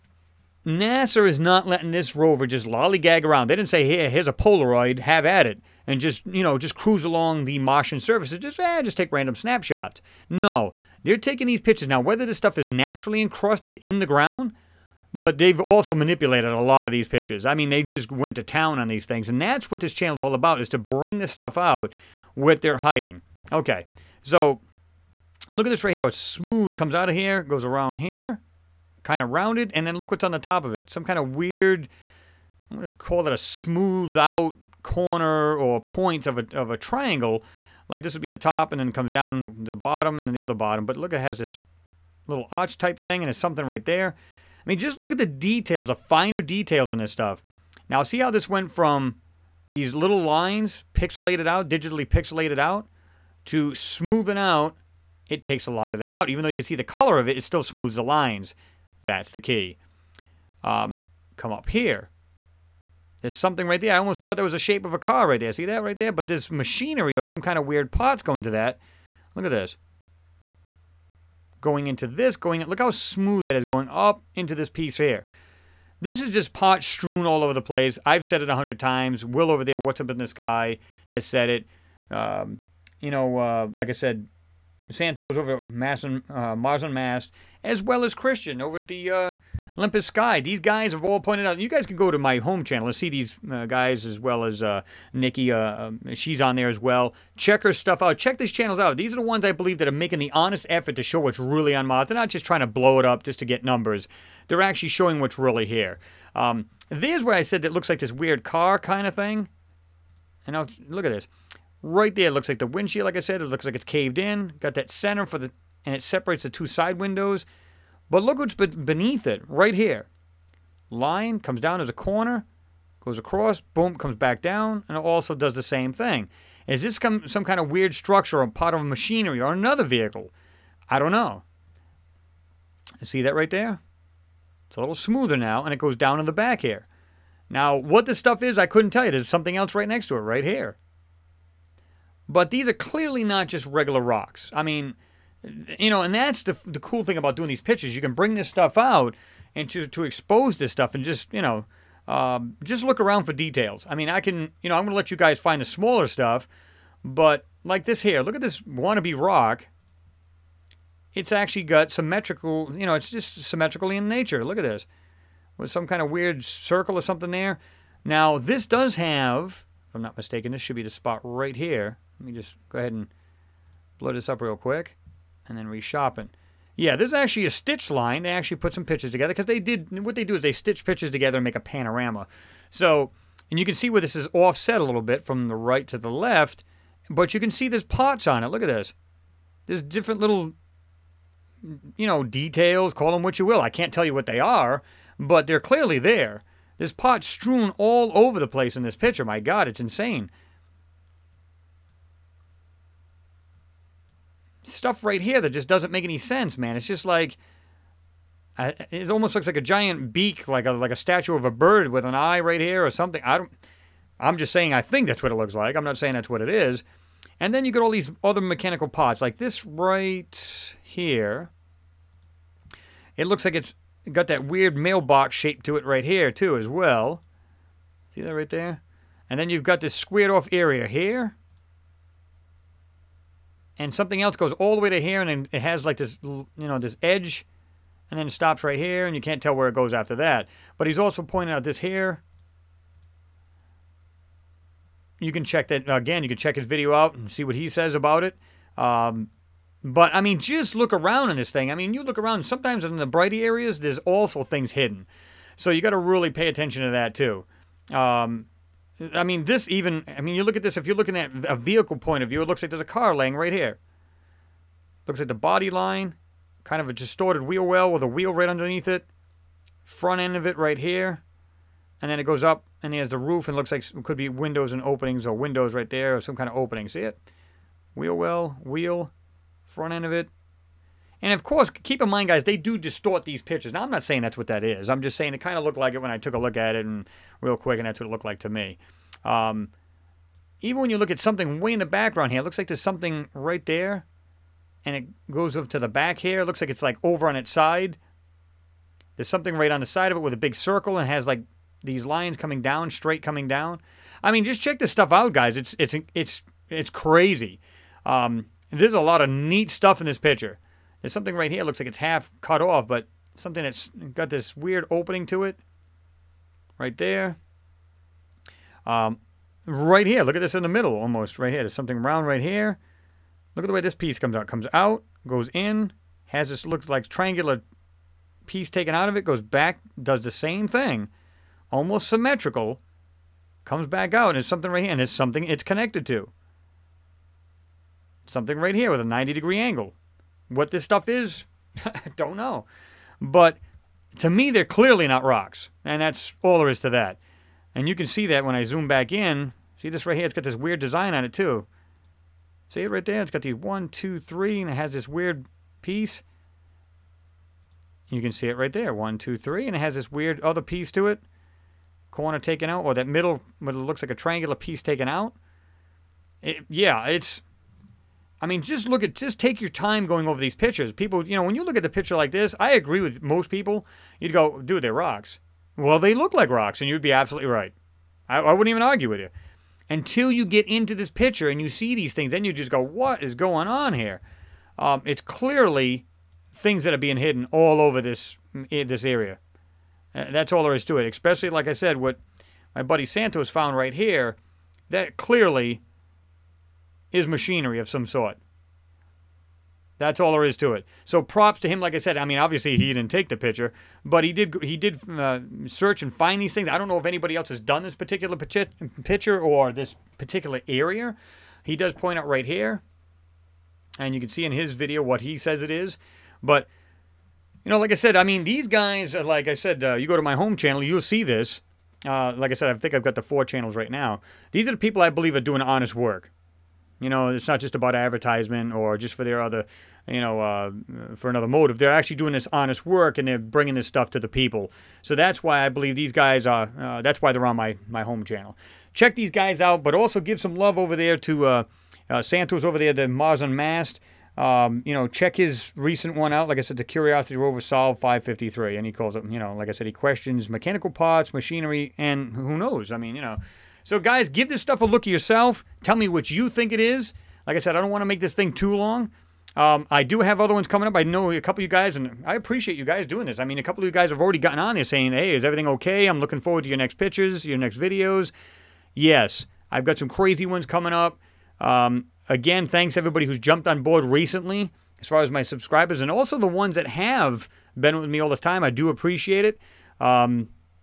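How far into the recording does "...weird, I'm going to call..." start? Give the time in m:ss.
0:31.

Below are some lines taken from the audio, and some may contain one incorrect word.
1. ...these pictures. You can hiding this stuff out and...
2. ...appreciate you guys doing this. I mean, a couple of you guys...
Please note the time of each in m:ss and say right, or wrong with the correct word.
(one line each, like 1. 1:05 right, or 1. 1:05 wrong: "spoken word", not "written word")
1. 2:27 wrong: "bring", not "hiding"
2. 7:42 right.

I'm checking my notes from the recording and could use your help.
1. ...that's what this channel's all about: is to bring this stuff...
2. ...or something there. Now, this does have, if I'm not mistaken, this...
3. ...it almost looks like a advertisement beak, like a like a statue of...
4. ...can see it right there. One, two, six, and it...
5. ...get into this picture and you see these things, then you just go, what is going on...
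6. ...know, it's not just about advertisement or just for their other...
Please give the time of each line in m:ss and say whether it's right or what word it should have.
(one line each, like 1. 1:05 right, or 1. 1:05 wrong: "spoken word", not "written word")
1. 0:19 right
2. 2:46 right
3. 3:28 wrong: "giant", not "advertisement"
4. 5:58 wrong: "three", not "six"
5. 6:20 right
6. 7:07 right.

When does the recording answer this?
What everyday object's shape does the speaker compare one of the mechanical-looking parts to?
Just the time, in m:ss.
3:44.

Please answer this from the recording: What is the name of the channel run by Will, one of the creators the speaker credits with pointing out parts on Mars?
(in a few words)
What's Up in the Sky.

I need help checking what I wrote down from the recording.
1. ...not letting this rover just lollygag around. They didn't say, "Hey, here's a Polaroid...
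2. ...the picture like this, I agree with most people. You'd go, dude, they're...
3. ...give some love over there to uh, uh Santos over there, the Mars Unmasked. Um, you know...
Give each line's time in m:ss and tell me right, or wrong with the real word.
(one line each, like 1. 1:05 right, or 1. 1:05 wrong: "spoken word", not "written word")
1. 0:01 right
2. 6:11 right
3. 7:20 right.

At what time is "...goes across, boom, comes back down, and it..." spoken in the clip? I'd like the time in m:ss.
2:02.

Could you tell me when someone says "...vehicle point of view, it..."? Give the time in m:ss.
4:21.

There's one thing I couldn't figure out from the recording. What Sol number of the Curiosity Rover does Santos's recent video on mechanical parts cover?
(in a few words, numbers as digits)
553.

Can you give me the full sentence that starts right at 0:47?
Now, see how this went from these little lines pixelated out, digitally pixelated out, to smoothing out.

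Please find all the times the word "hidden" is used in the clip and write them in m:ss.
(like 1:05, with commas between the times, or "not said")
4:14, 6:27.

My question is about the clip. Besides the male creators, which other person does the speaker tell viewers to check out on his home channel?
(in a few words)
Nikki.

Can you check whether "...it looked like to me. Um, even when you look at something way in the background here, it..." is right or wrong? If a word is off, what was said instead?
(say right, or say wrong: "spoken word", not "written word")
right.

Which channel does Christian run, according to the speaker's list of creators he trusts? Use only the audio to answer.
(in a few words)
Olympus Sky.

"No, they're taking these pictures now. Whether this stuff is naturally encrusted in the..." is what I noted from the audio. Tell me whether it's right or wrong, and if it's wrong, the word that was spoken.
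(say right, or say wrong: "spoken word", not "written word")
right.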